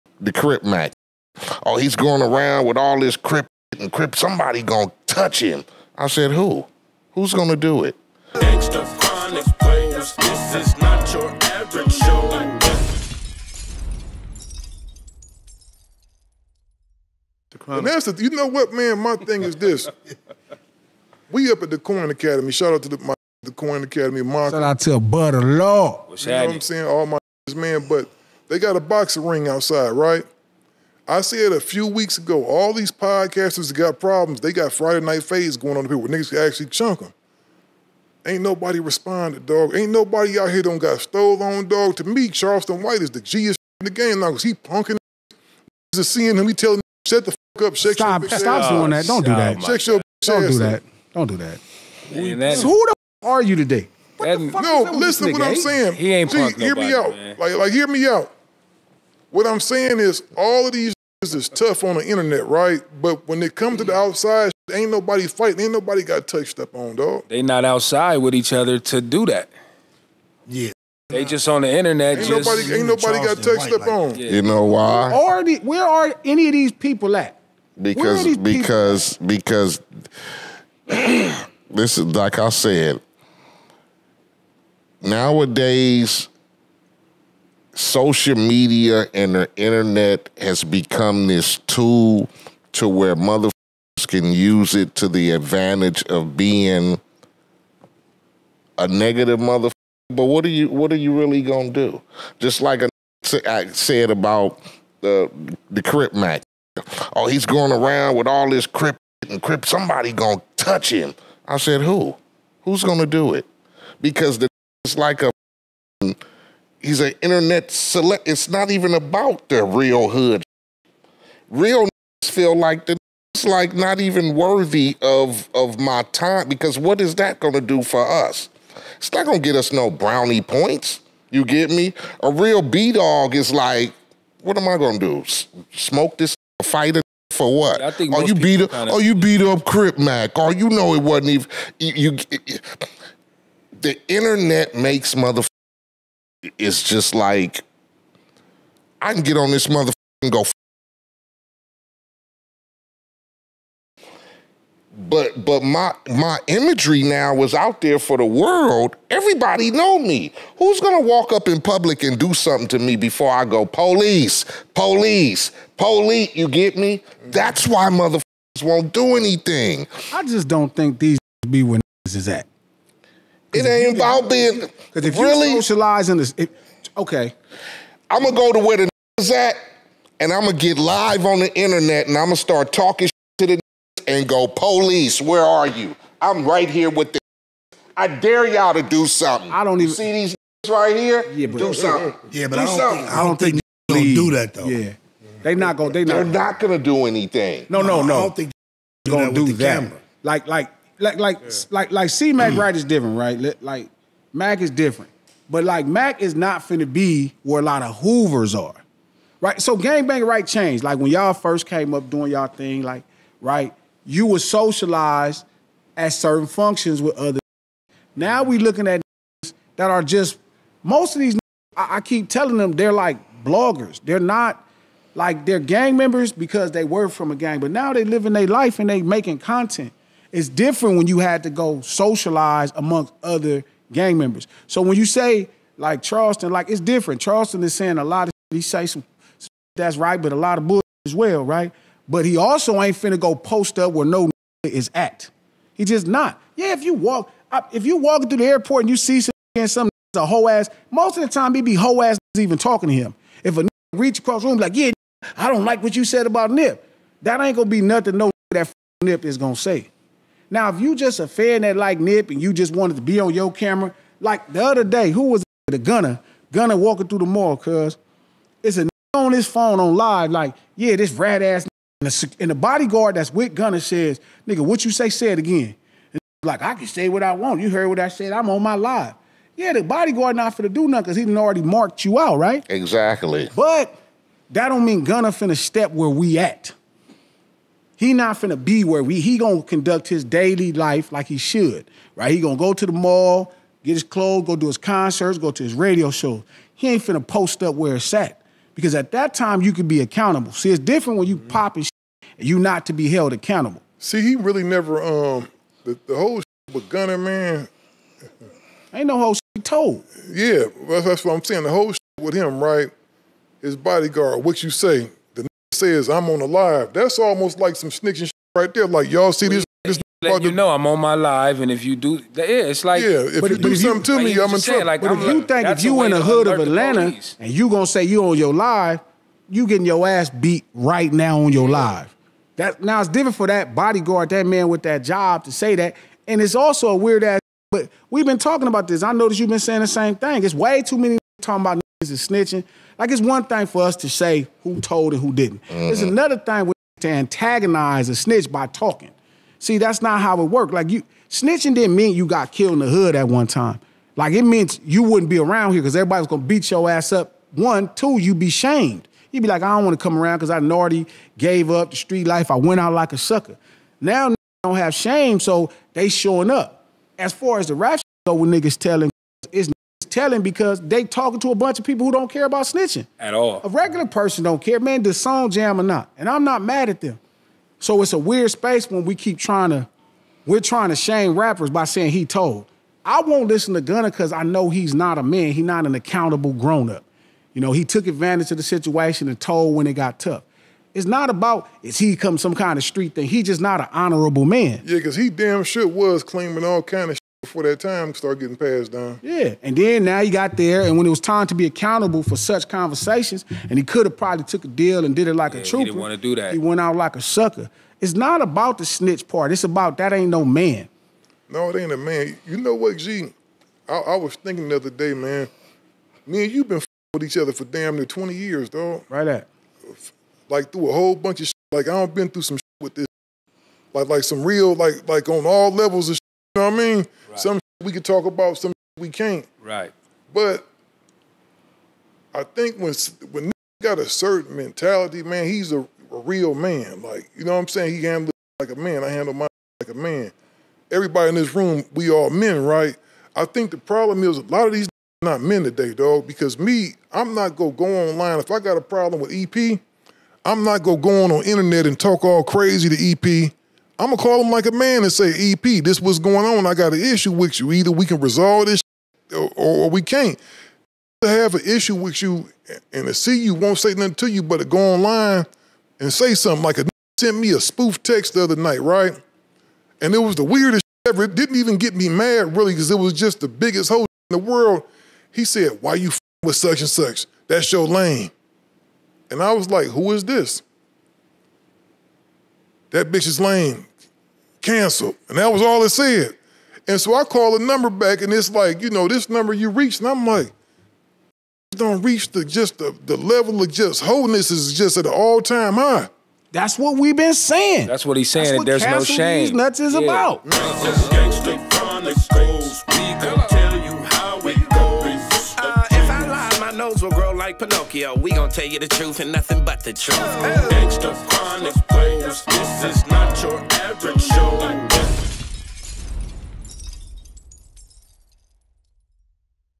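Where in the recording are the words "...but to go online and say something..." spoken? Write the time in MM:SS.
07:44.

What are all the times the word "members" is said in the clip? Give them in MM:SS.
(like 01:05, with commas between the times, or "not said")
03:45, 03:54.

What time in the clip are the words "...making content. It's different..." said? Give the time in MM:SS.
03:49.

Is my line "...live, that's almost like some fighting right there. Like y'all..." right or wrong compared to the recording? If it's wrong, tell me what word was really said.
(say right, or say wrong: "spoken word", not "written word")
wrong: "snitching", not "fighting".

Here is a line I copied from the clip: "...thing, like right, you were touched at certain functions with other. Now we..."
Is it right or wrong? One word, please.
wrong.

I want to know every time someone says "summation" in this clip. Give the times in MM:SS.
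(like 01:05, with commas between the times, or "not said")
not said.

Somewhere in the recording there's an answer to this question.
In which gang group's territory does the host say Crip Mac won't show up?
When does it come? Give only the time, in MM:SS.
03:27.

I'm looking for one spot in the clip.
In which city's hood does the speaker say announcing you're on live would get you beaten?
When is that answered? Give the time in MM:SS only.
05:26.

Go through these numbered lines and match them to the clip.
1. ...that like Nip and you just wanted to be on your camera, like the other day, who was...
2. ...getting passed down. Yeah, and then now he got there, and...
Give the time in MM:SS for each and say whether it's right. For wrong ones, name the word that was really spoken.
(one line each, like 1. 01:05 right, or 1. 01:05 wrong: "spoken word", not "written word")
1. 04:21 right
2. 06:38 right.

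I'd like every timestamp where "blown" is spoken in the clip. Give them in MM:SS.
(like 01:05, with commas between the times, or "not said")
not said.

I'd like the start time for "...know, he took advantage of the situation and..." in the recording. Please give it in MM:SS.
06:27.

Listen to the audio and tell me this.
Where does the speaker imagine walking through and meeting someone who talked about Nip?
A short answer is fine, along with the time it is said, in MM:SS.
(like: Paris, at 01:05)
Airport, at 04:08.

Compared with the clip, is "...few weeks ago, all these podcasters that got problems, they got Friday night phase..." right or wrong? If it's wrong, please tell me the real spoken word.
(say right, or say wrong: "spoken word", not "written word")
right.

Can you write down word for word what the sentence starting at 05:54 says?
Like it means you wouldn't be around here because everybody's gonna beat your ass up.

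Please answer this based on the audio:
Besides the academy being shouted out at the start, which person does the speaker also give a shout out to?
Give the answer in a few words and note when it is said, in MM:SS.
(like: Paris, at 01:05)
Butter Law, at 00:24.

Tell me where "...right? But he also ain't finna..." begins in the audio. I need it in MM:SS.
04:01.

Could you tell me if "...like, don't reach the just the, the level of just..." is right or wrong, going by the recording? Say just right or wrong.
right.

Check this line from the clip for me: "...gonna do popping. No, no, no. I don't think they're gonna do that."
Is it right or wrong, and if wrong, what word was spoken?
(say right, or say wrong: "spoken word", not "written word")
wrong: "anything", not "popping".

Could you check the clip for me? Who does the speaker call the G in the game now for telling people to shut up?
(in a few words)
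Charleston White.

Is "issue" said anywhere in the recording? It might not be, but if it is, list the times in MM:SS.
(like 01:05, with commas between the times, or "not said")
07:36, 07:41.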